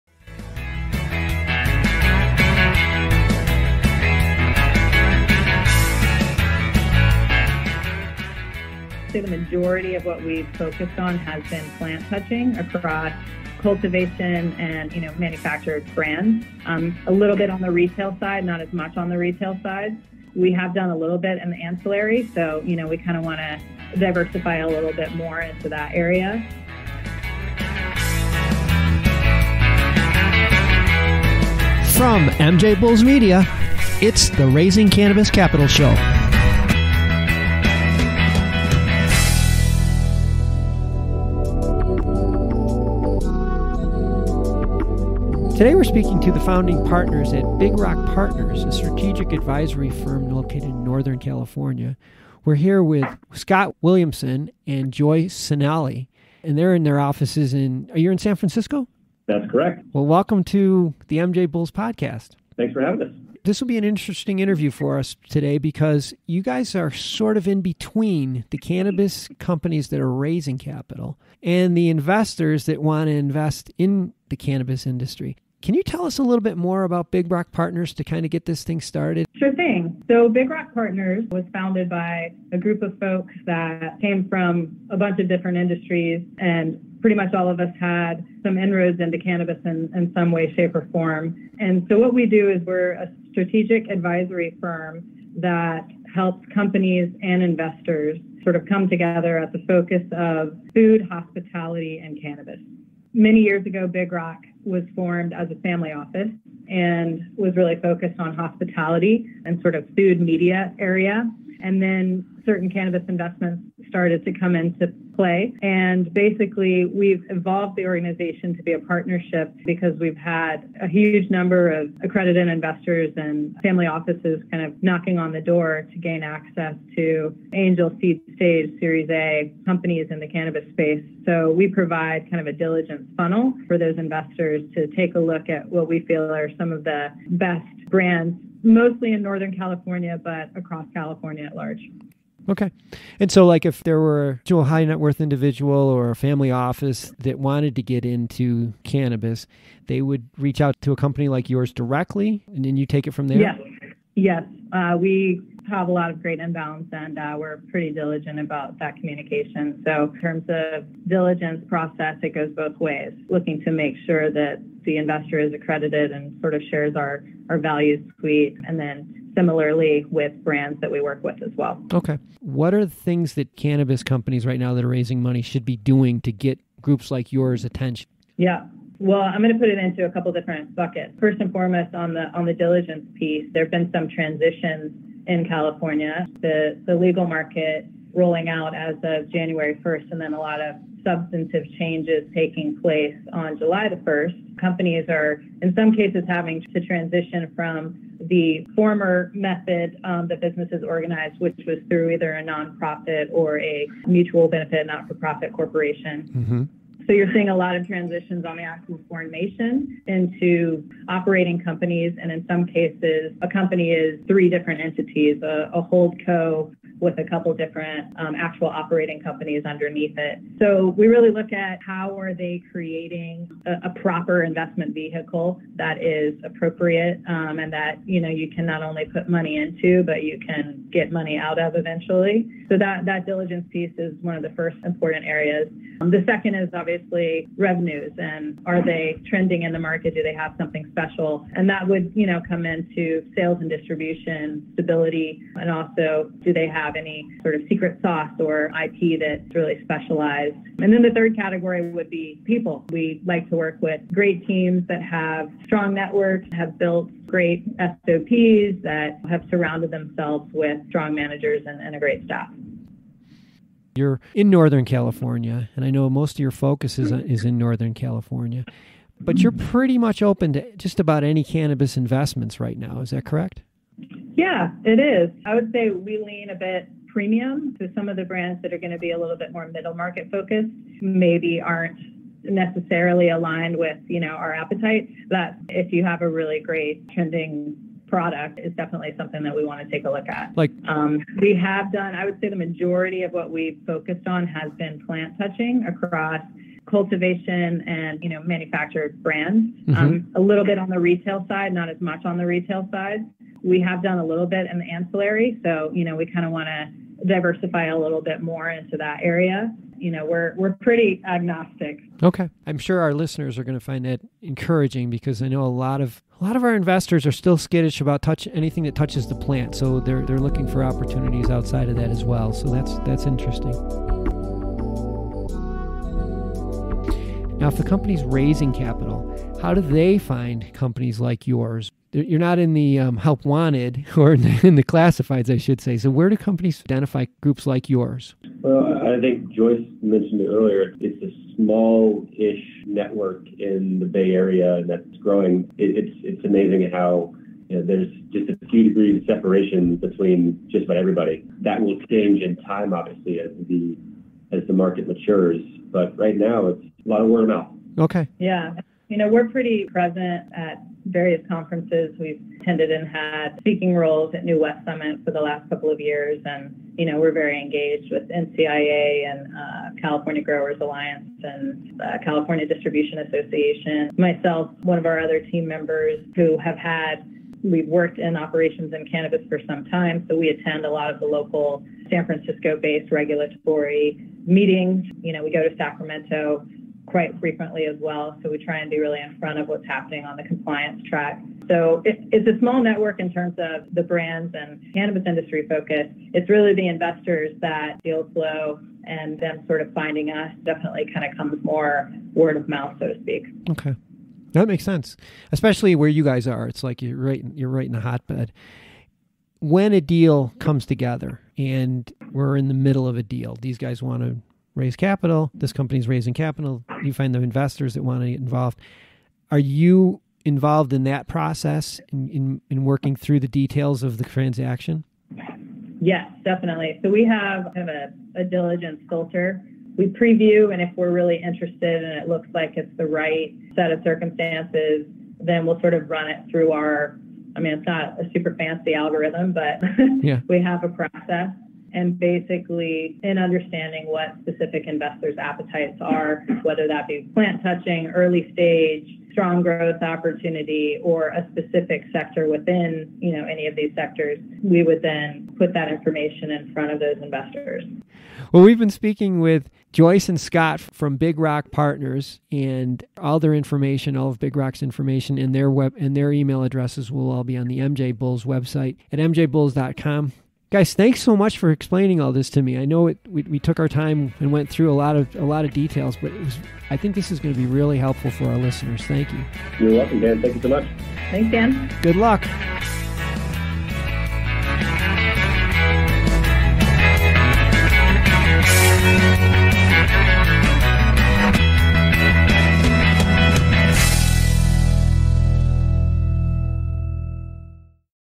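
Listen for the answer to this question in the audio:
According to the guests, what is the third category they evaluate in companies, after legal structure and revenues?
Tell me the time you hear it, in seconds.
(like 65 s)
252 s.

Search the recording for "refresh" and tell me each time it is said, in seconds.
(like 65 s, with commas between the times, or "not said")
not said.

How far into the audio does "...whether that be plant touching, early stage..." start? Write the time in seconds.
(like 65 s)
446 s.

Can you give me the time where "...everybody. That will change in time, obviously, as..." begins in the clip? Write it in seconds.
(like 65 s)
350 s.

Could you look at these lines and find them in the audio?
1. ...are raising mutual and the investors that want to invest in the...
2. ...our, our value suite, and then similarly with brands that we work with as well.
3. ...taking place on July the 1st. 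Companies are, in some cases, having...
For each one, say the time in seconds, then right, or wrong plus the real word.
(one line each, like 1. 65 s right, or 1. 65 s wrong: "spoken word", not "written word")
1. 69 s wrong: "capital", not "mutual"
2. 166 s right
3. 192 s right.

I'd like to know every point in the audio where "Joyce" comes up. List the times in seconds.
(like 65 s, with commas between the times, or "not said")
54 s, 339 s, 459 s.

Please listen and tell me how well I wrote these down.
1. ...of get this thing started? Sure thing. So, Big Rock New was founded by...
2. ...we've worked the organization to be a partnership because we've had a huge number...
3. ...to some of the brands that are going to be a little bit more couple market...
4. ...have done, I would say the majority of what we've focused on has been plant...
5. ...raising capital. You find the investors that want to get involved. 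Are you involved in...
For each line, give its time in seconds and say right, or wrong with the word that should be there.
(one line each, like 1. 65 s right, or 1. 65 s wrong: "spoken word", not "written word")
1. 78 s wrong: "Partners", not "New"
2. 116 s wrong: "evolved", not "worked"
3. 277 s wrong: "middle", not "couple"
4. 291 s right
5. 416 s right.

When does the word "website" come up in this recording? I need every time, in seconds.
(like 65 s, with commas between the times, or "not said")
468 s.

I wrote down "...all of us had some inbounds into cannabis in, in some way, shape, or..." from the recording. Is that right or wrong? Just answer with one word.
wrong.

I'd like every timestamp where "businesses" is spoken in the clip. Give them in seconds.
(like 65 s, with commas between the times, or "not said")
200 s.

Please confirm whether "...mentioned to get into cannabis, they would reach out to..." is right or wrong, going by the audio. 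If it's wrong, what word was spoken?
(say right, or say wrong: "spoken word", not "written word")
wrong: "wanted", not "mentioned".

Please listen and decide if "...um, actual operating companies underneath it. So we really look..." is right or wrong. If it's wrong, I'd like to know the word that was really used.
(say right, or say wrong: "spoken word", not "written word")
right.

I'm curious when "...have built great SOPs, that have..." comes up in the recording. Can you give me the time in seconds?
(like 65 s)
256 s.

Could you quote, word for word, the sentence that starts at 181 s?
First and foremost, on the on the diligence piece, there have been some transitions in California.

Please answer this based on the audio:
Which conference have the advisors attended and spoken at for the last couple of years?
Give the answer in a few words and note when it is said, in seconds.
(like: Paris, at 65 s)
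New West Summit, at 364 s.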